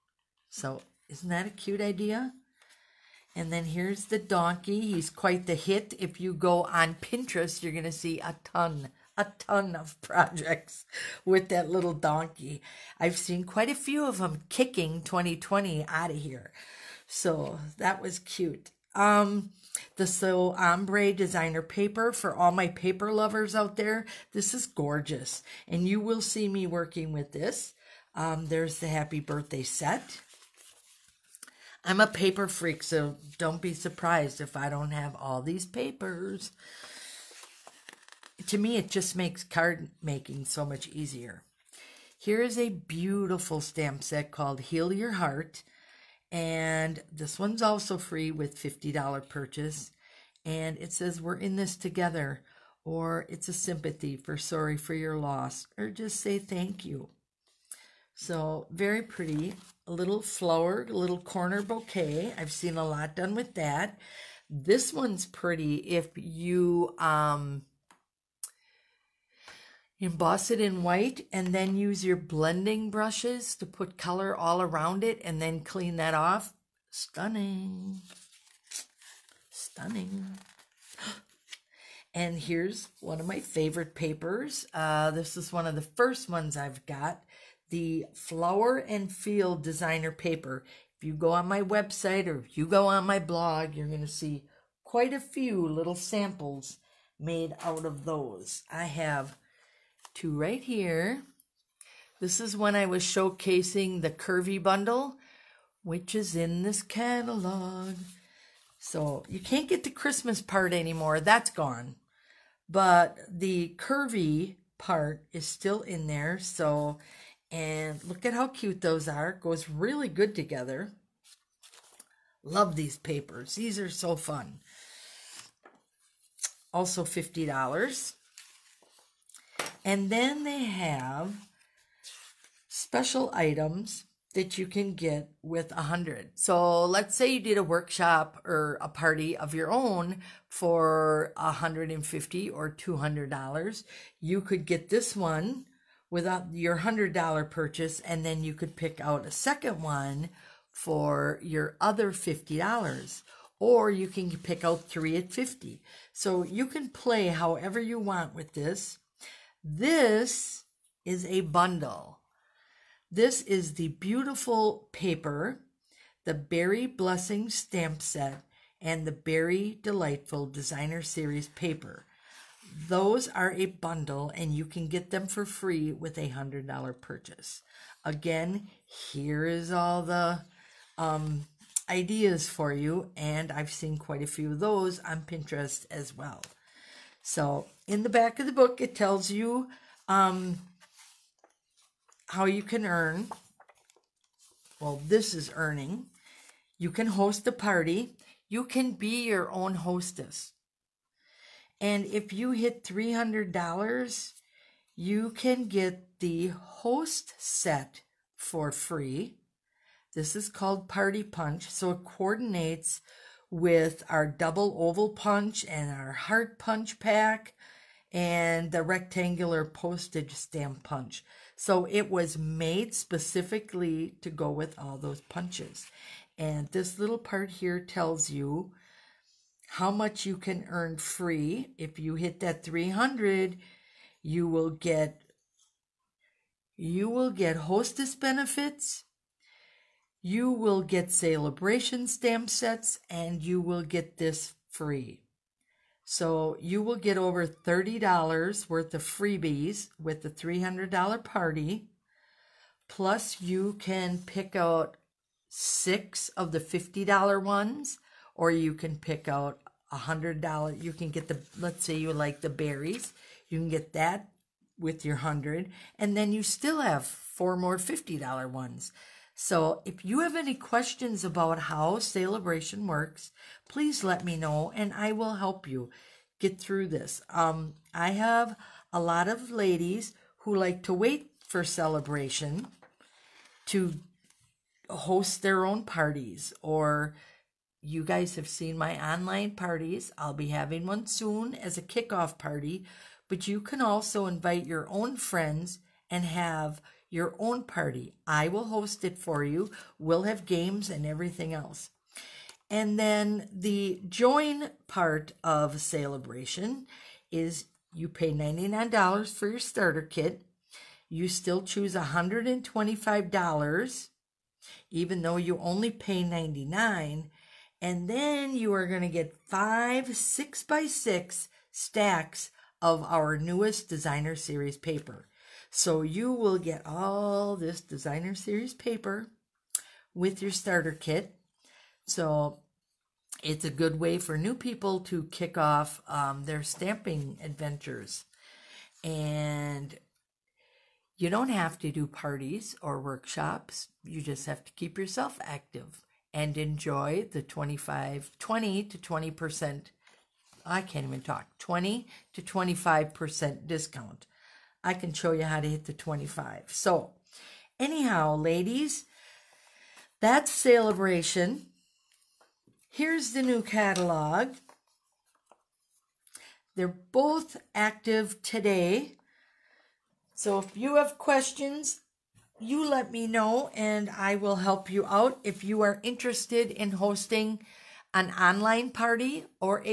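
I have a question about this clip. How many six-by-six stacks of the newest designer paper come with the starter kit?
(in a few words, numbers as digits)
5.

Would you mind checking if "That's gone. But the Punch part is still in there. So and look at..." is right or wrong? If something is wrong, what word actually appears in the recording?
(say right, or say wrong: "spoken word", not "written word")
wrong: "Curvy", not "Punch".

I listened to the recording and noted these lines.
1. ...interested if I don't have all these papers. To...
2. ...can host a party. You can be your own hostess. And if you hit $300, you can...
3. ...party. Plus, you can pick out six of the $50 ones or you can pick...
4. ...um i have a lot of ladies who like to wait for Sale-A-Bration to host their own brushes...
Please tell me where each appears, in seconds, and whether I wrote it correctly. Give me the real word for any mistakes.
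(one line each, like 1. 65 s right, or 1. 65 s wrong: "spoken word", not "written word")
1. 33 s wrong: "surprised", not "interested"
2. 196 s right
3. 251 s right
4. 277 s wrong: "parties", not "brushes".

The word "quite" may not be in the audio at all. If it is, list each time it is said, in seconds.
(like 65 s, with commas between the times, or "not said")
5 s, 13 s, 94 s, 183 s.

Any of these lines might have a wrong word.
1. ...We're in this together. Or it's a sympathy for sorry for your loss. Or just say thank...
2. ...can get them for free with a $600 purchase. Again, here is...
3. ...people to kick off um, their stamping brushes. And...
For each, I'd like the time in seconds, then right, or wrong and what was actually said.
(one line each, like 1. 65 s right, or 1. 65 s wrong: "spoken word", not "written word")
1. 51 s right
2. 174 s wrong: "100", not "600"
3. 334 s wrong: "adventures", not "brushes".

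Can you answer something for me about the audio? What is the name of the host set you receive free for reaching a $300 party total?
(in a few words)
Party Punch.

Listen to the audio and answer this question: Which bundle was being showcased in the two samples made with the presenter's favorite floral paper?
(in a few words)
Curvy Bundle.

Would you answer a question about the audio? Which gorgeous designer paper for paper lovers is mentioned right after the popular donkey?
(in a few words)
So Ombre.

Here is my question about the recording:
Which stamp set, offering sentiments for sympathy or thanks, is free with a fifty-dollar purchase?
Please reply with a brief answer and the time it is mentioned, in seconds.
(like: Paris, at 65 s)
Heal Your Heart, at 44 s.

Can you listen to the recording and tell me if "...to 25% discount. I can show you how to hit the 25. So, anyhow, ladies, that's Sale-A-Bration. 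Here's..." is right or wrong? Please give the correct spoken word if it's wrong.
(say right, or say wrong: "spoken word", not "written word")
right.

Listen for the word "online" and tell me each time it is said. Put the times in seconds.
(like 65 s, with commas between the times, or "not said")
289 s, 378 s.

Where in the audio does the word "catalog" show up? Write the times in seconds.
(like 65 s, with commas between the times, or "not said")
106 s, 363 s.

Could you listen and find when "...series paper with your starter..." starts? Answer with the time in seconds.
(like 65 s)
328 s.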